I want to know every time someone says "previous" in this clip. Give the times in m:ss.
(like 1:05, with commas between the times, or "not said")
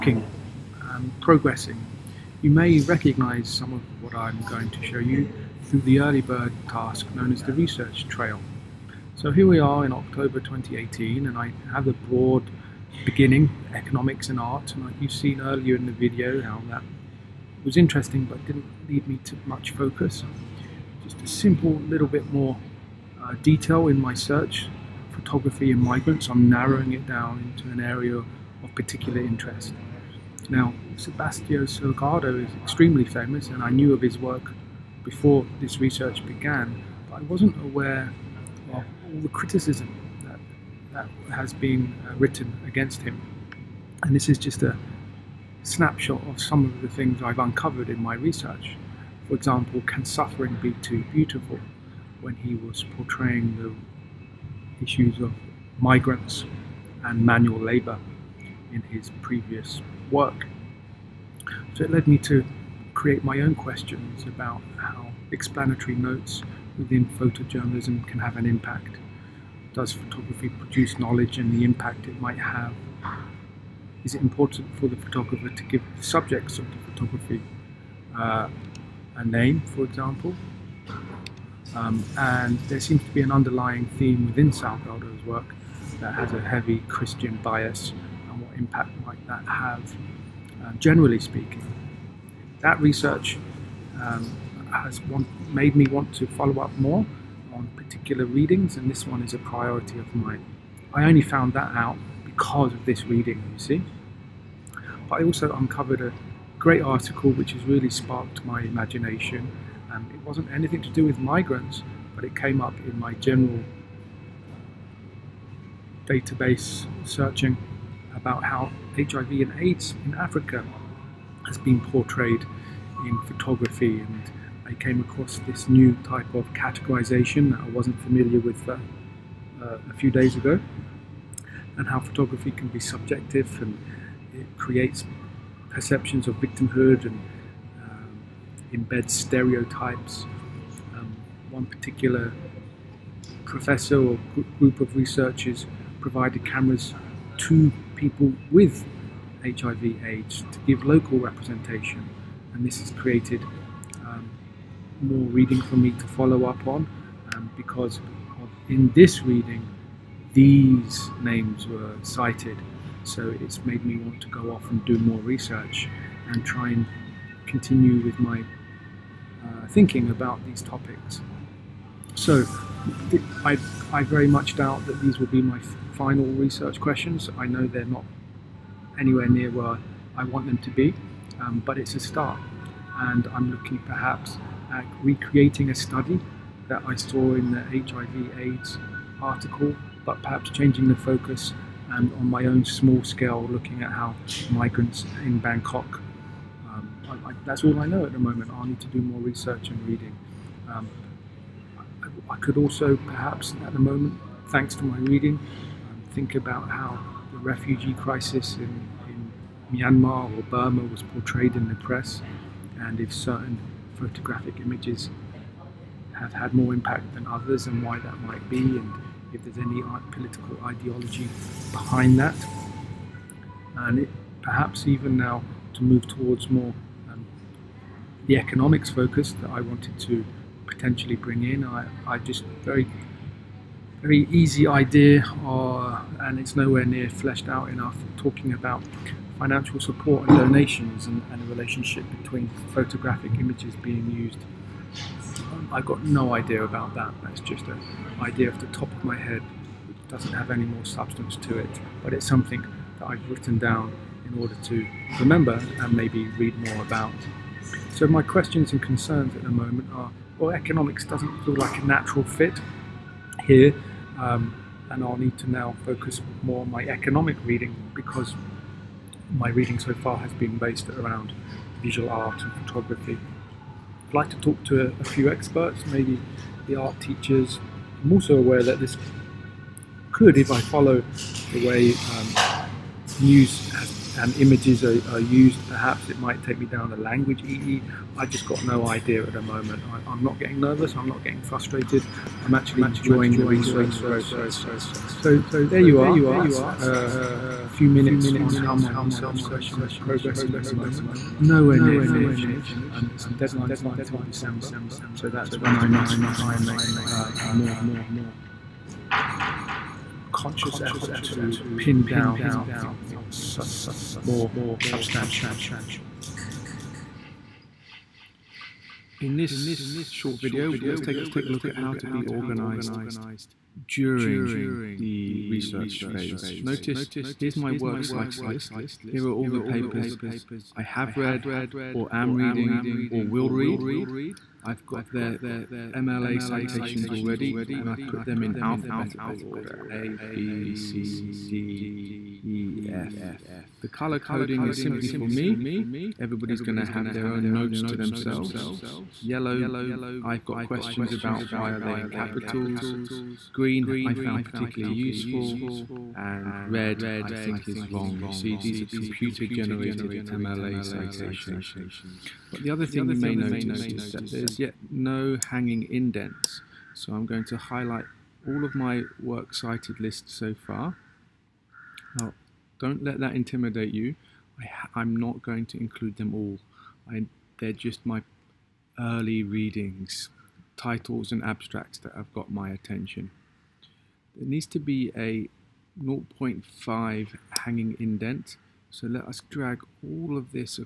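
0:59.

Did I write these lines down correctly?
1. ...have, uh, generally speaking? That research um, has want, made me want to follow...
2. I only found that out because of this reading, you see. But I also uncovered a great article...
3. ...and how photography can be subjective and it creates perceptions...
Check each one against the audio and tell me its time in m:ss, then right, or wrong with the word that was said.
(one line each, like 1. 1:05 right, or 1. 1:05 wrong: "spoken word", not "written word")
1. 1:29 right
2. 1:40 right
3. 2:11 right.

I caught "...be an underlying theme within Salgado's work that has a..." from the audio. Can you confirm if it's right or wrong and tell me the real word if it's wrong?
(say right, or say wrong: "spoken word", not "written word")
right.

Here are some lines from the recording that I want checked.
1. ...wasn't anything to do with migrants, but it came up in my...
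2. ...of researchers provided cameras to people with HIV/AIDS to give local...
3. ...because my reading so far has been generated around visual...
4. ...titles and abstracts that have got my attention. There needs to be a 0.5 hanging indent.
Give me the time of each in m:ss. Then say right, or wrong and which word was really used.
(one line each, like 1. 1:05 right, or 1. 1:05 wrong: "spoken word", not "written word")
1. 1:50 right
2. 2:24 right
3. 4:27 wrong: "based", not "generated"
4. 6:20 right.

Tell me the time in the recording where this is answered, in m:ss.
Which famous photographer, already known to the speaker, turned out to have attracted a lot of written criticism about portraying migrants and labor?
0:30.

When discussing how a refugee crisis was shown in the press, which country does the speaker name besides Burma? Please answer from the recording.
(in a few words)
Myanmar.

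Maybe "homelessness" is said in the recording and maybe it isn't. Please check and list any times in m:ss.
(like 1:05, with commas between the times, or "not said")
not said.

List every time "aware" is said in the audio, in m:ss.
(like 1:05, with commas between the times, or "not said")
0:37, 4:38.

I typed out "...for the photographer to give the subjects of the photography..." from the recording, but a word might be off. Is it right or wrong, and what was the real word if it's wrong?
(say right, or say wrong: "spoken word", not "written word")
right.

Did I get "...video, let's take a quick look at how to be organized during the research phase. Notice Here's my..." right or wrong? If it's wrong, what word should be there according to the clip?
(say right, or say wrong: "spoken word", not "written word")
right.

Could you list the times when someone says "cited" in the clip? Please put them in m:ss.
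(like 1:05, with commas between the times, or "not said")
2:42, 5:28, 6:09.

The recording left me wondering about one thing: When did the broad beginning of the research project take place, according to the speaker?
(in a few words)
October 2018.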